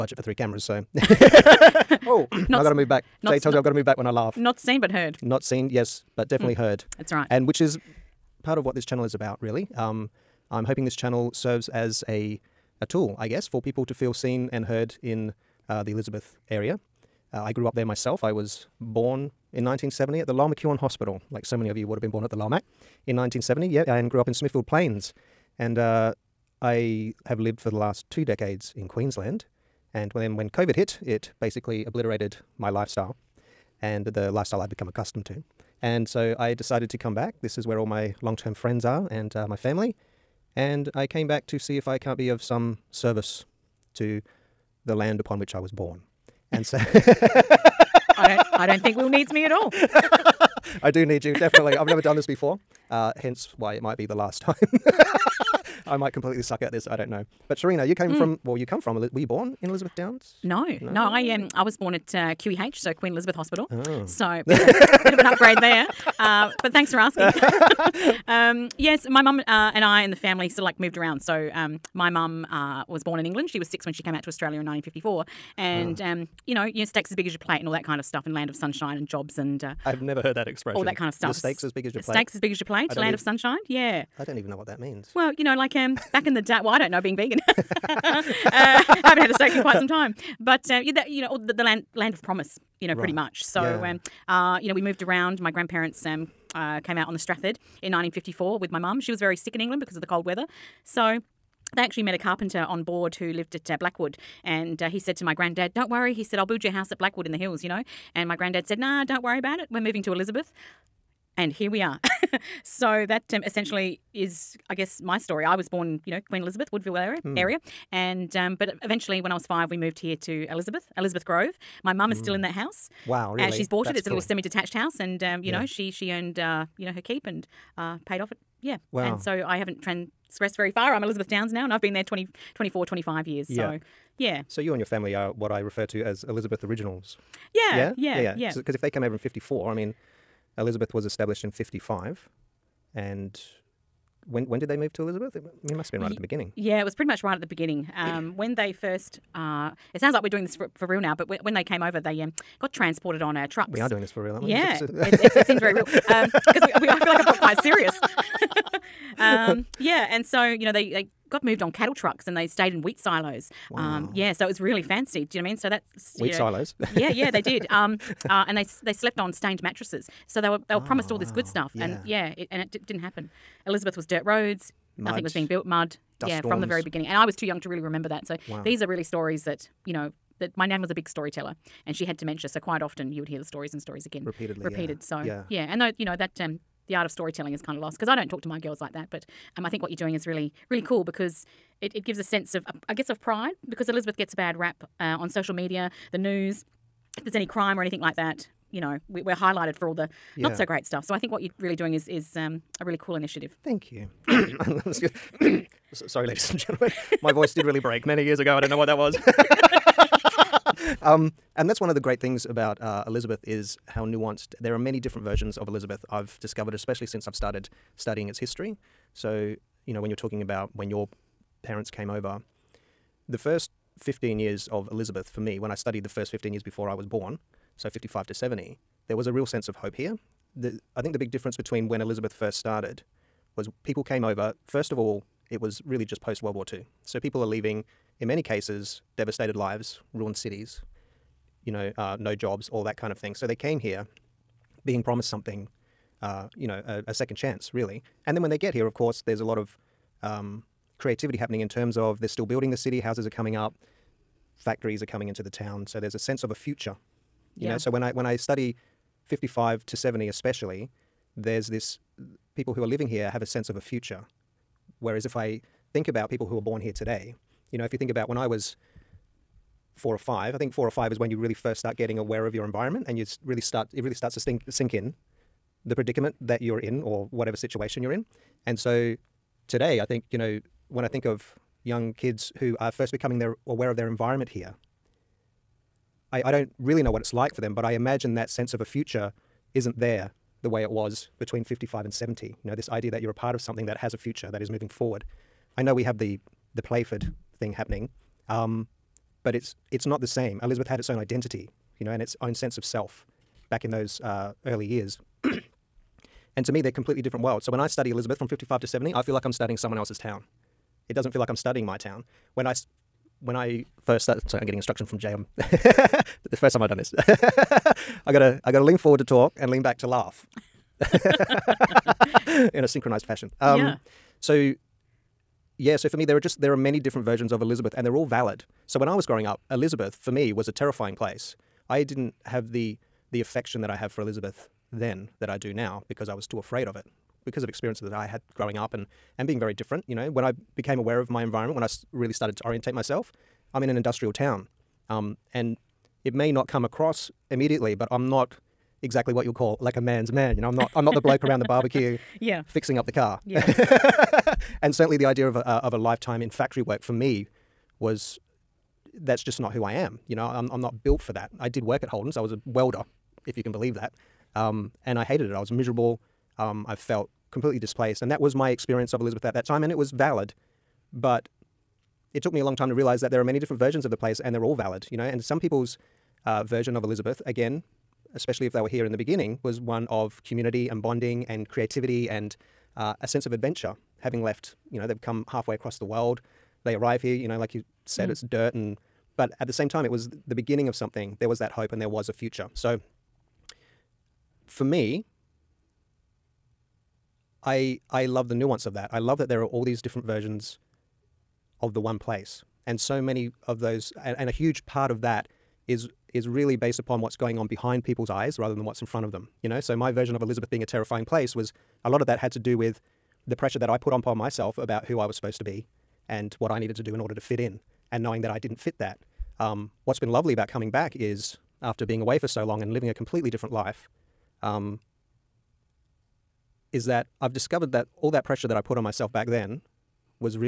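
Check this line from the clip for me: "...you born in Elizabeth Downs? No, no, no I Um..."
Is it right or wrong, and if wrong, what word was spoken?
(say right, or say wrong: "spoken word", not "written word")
right.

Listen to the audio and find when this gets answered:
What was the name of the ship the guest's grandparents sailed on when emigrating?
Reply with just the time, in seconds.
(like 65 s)
97 s.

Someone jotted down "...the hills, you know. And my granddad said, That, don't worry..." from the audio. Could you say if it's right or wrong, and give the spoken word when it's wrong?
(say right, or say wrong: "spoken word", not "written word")
wrong: "Nah", not "That".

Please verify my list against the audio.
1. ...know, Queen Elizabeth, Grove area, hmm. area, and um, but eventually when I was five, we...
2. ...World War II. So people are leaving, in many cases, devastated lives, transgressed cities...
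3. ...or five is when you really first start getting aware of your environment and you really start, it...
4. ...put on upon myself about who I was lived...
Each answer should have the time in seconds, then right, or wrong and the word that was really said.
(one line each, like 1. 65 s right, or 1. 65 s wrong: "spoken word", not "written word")
1. 116 s wrong: "Woodville", not "Grove"
2. 236 s wrong: "ruined", not "transgressed"
3. 270 s right
4. 413 s wrong: "supposed", not "lived".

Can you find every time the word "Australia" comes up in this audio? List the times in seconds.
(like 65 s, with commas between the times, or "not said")
74 s.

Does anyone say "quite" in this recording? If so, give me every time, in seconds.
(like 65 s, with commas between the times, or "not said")
89 s, 157 s, 182 s.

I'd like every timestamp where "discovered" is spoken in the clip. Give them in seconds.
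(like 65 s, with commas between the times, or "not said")
216 s, 427 s.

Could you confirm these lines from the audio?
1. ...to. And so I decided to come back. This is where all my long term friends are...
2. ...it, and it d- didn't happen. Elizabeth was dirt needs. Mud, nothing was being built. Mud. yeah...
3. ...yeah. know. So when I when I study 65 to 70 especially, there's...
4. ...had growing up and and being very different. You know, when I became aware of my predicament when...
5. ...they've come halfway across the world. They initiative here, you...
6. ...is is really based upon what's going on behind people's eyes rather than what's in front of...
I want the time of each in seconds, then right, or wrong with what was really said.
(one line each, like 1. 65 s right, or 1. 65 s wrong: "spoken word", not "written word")
1. 35 s right
2. 172 s wrong: "roads", not "needs"
3. 257 s wrong: "55", not "65"
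4. 338 s wrong: "environment", not "predicament"
5. 385 s wrong: "arrive", not "initiative"
6. 405 s right.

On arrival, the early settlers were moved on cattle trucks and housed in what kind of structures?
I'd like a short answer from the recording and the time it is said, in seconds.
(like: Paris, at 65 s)
wheat silos, at 162 s.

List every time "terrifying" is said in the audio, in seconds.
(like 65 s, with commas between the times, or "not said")
330 s, 410 s.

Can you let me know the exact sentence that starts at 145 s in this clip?
It, it must have been right at the beginning.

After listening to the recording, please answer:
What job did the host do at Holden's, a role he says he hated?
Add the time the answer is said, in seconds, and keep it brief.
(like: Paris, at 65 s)
welder, at 362 s.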